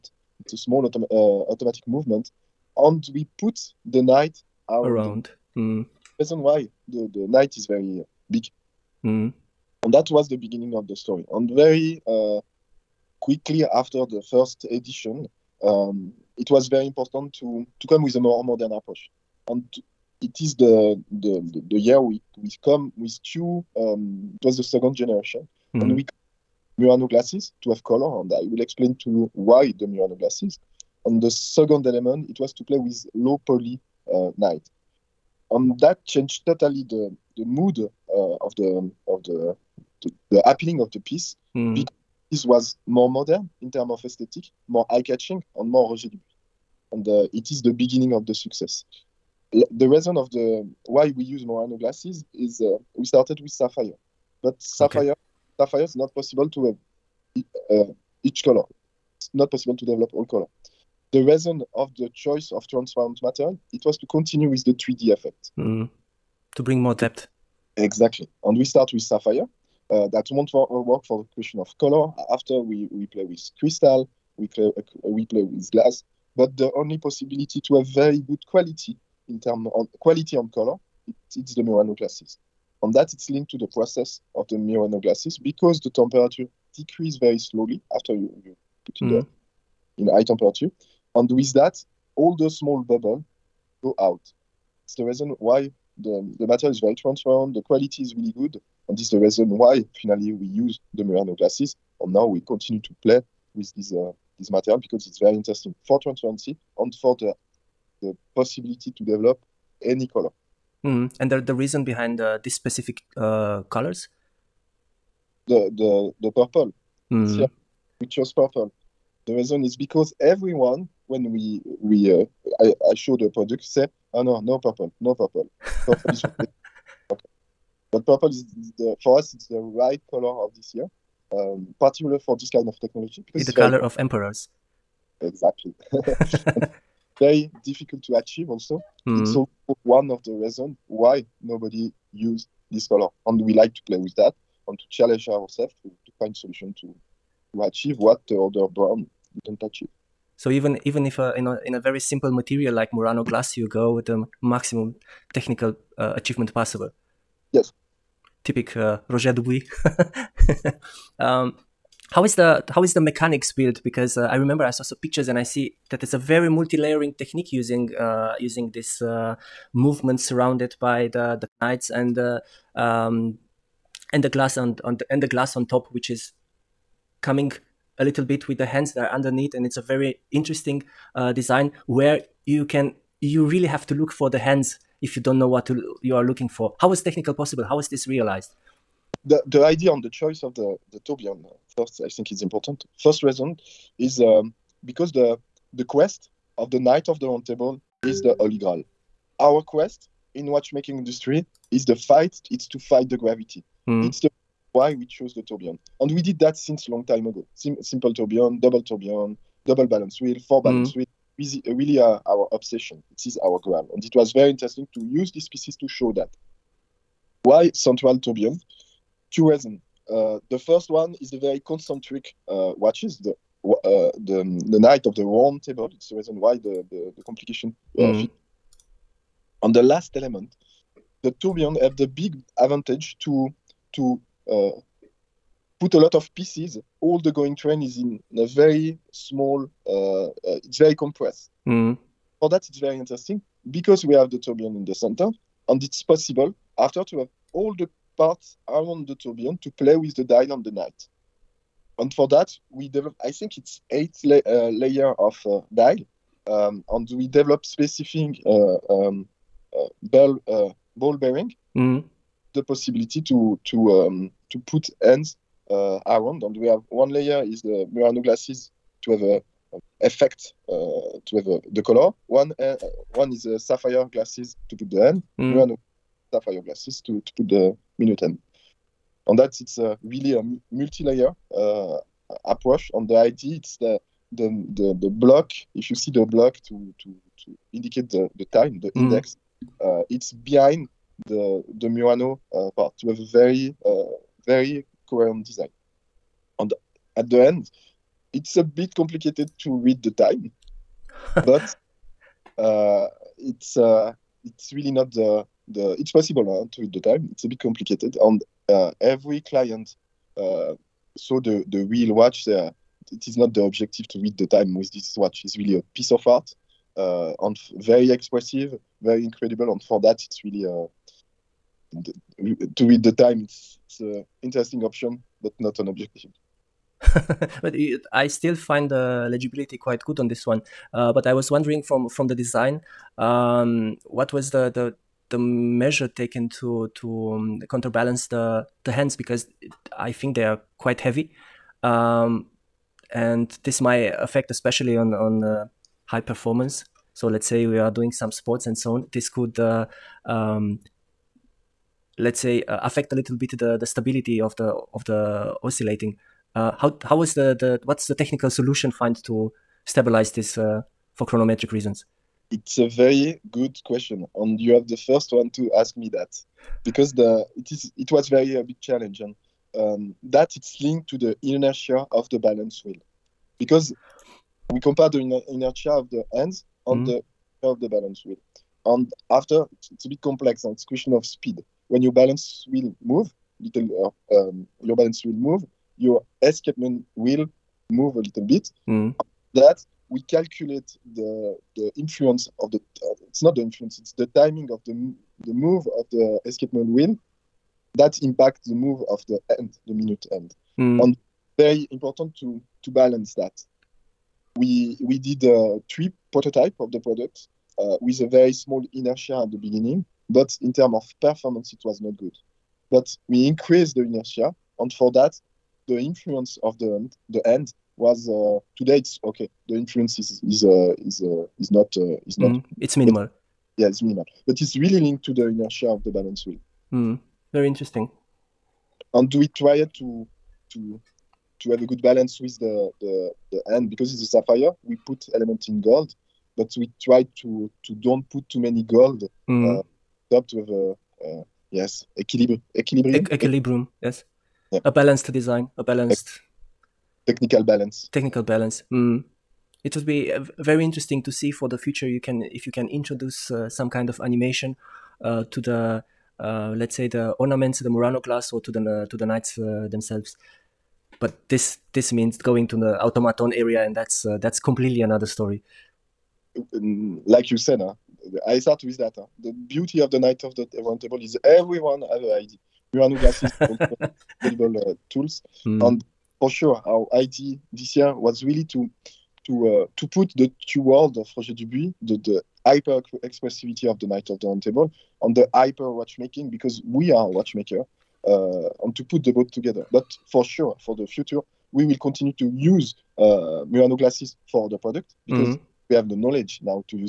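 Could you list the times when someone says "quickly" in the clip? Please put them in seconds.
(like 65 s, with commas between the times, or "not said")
13 s.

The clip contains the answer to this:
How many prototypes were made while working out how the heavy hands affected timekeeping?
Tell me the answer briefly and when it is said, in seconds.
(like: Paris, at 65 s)
3, at 405 s.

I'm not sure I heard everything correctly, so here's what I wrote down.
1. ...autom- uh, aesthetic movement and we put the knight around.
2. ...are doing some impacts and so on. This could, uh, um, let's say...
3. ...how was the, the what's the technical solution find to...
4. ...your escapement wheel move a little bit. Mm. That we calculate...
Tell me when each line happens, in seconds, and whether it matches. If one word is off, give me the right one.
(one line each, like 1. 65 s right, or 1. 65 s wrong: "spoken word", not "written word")
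1. 0 s wrong: "automatic", not "aesthetic"
2. 347 s wrong: "sports", not "impacts"
3. 357 s right
4. 385 s right.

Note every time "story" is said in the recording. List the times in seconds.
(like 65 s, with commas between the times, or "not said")
10 s, 465 s.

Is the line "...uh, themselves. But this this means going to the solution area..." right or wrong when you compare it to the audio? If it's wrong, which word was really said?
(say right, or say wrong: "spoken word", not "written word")
wrong: "automaton", not "solution".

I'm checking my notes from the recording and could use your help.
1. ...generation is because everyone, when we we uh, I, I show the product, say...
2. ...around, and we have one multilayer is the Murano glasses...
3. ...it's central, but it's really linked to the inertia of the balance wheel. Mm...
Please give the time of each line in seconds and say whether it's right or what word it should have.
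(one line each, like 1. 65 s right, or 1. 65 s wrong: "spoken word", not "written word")
1. 119 s wrong: "reason", not "generation"
2. 266 s wrong: "layer", not "multilayer"
3. 423 s wrong: "minimal", not "central".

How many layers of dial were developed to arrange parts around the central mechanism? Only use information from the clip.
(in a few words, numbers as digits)
8.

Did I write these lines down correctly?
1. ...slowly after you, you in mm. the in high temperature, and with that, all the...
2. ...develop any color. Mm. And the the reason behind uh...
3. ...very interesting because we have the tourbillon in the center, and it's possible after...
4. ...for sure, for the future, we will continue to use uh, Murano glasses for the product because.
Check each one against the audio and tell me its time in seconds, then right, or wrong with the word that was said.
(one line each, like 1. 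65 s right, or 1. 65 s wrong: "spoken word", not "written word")
1. 87 s right
2. 109 s right
3. 242 s right
4. 490 s right.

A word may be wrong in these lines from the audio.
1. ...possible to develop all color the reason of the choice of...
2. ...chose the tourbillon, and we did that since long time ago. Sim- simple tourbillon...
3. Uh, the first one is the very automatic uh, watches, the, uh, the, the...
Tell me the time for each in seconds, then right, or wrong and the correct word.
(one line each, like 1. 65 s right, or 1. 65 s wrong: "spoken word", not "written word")
1. 59 s right
2. 205 s right
3. 220 s wrong: "concentric", not "automatic".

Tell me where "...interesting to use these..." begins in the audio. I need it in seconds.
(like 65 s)
214 s.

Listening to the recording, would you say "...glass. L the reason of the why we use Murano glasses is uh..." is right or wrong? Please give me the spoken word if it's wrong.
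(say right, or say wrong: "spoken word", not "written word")
wrong: "success", not "glass".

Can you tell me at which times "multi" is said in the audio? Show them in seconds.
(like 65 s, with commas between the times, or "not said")
166 s, 280 s.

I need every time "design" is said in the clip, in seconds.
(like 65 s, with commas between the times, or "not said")
181 s, 295 s, 332 s, 445 s.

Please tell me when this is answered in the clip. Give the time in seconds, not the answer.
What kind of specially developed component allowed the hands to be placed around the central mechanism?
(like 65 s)
260 s.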